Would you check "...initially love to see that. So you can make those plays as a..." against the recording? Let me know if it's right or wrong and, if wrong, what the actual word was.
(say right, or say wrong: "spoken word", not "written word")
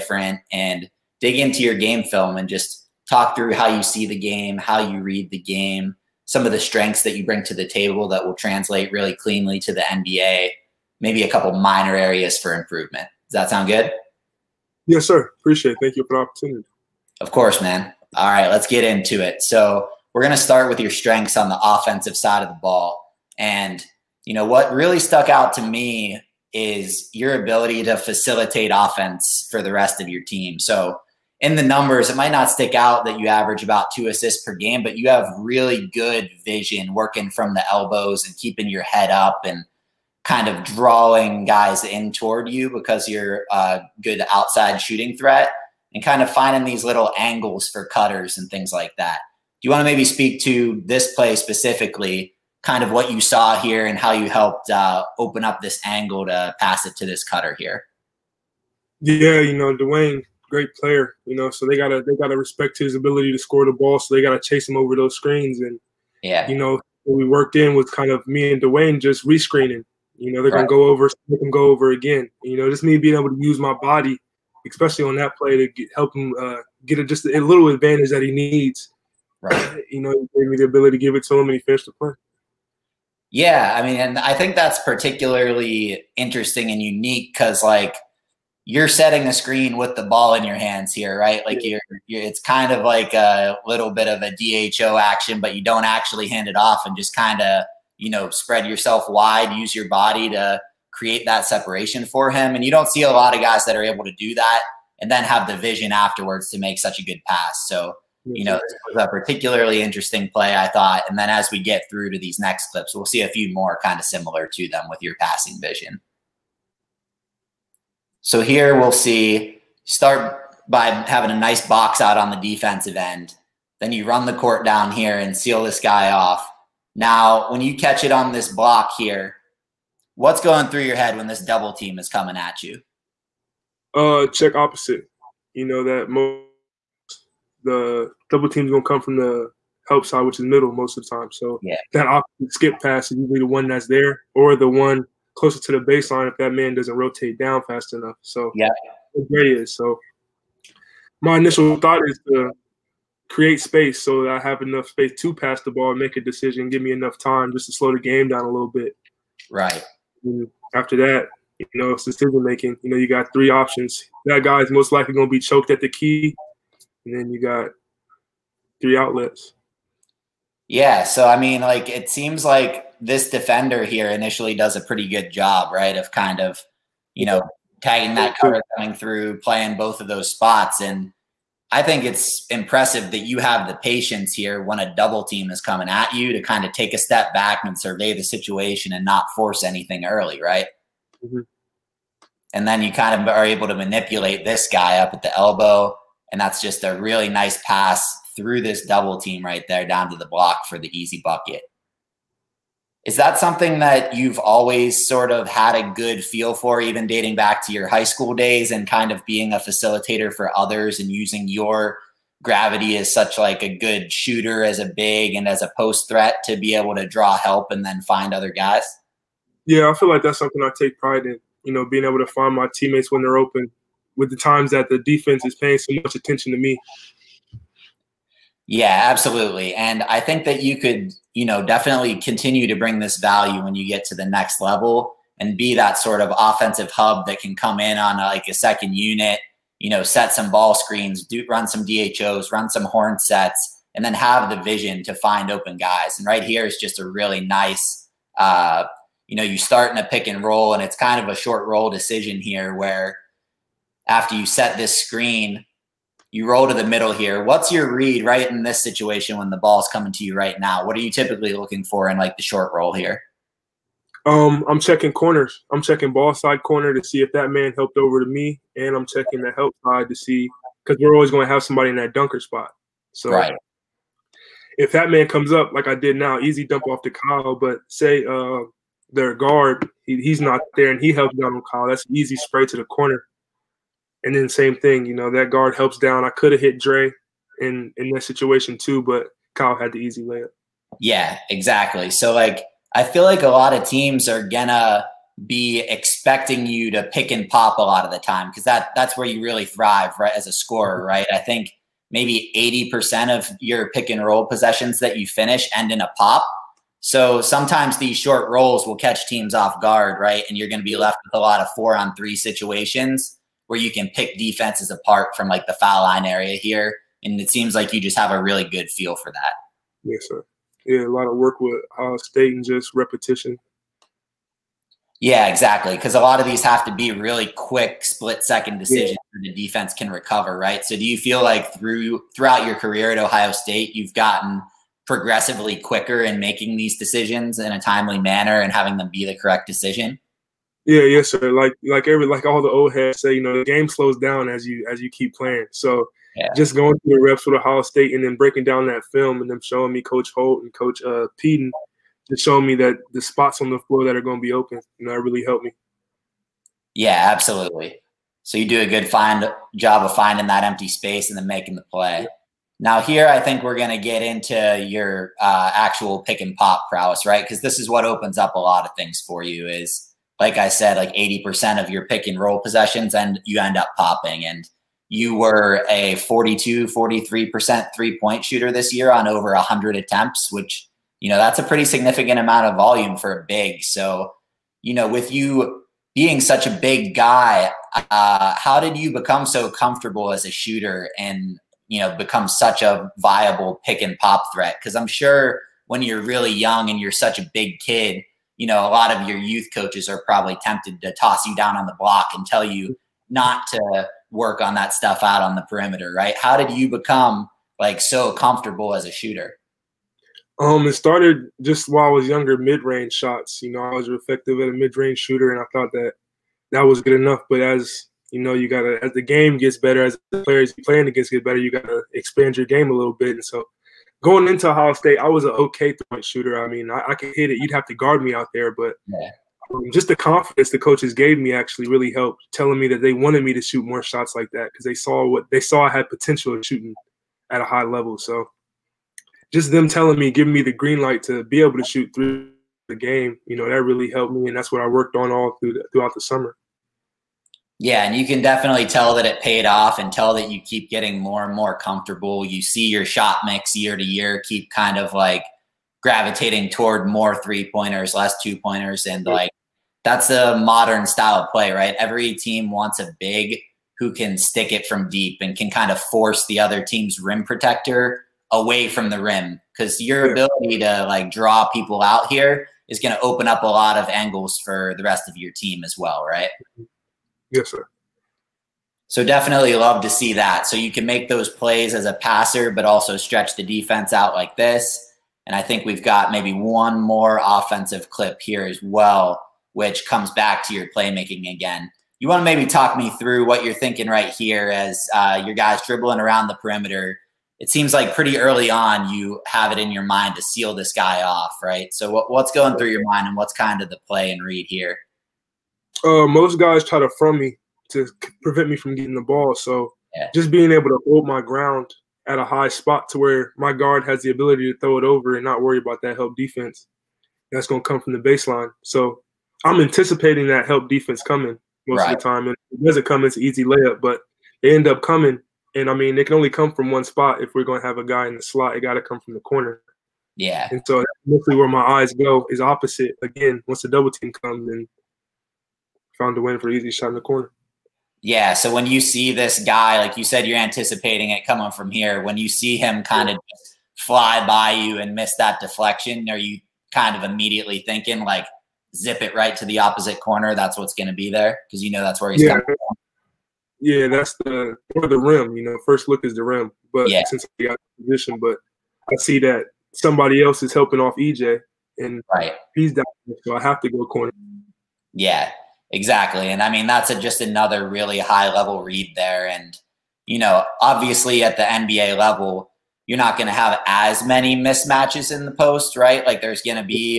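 wrong: "definitely", not "initially".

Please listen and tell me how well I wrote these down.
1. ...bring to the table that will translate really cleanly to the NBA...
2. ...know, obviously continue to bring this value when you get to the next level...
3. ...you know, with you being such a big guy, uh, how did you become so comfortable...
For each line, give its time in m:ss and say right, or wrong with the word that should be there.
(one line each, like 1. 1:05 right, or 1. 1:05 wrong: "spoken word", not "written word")
1. 0:07 right
2. 3:51 wrong: "definitely", not "obviously"
3. 6:24 right.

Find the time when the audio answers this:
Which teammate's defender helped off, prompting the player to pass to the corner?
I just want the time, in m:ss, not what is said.
9:21.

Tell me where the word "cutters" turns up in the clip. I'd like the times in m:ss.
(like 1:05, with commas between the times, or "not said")
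0:47, 0:57.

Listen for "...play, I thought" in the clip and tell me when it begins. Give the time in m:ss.
1:50.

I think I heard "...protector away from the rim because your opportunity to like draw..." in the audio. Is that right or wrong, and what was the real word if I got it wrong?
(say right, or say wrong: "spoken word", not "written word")
wrong: "ability", not "opportunity".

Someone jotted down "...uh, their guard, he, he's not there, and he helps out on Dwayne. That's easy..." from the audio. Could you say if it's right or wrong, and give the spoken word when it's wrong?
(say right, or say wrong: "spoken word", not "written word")
wrong: "Kyle", not "Dwayne".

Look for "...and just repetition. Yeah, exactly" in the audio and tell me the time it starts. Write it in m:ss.
5:22.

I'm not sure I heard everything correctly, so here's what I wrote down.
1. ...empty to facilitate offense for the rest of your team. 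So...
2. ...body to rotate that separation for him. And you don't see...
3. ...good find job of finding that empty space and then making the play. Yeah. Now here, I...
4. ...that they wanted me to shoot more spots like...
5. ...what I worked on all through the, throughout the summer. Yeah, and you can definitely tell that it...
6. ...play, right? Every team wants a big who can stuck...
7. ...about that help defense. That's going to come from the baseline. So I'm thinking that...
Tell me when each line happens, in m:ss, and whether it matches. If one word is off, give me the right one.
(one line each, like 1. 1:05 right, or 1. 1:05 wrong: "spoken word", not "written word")
1. 0:27 wrong: "ability", not "empty"
2. 1:39 wrong: "create", not "rotate"
3. 5:58 right
4. 7:12 wrong: "shots", not "spots"
5. 7:24 right
6. 7:41 wrong: "stick", not "stuck"
7. 8:35 wrong: "anticipating", not "thinking".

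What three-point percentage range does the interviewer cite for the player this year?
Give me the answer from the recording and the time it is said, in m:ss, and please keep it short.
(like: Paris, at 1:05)
42-43%, at 6:16.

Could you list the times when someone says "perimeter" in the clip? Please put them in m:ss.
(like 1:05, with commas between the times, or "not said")
6:45, 8:16.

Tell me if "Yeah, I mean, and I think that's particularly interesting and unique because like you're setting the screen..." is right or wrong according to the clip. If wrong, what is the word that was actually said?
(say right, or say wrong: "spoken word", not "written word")
right.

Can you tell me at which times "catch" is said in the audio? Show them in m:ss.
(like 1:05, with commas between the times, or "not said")
2:07, 5:08.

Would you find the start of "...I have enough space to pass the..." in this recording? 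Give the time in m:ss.
2:34.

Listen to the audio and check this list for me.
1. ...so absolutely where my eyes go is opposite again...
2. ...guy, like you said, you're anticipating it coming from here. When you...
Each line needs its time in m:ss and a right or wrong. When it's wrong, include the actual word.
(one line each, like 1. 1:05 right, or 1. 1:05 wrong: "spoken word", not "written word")
1. 8:50 wrong: "mostly", not "absolutely"
2. 8:59 right.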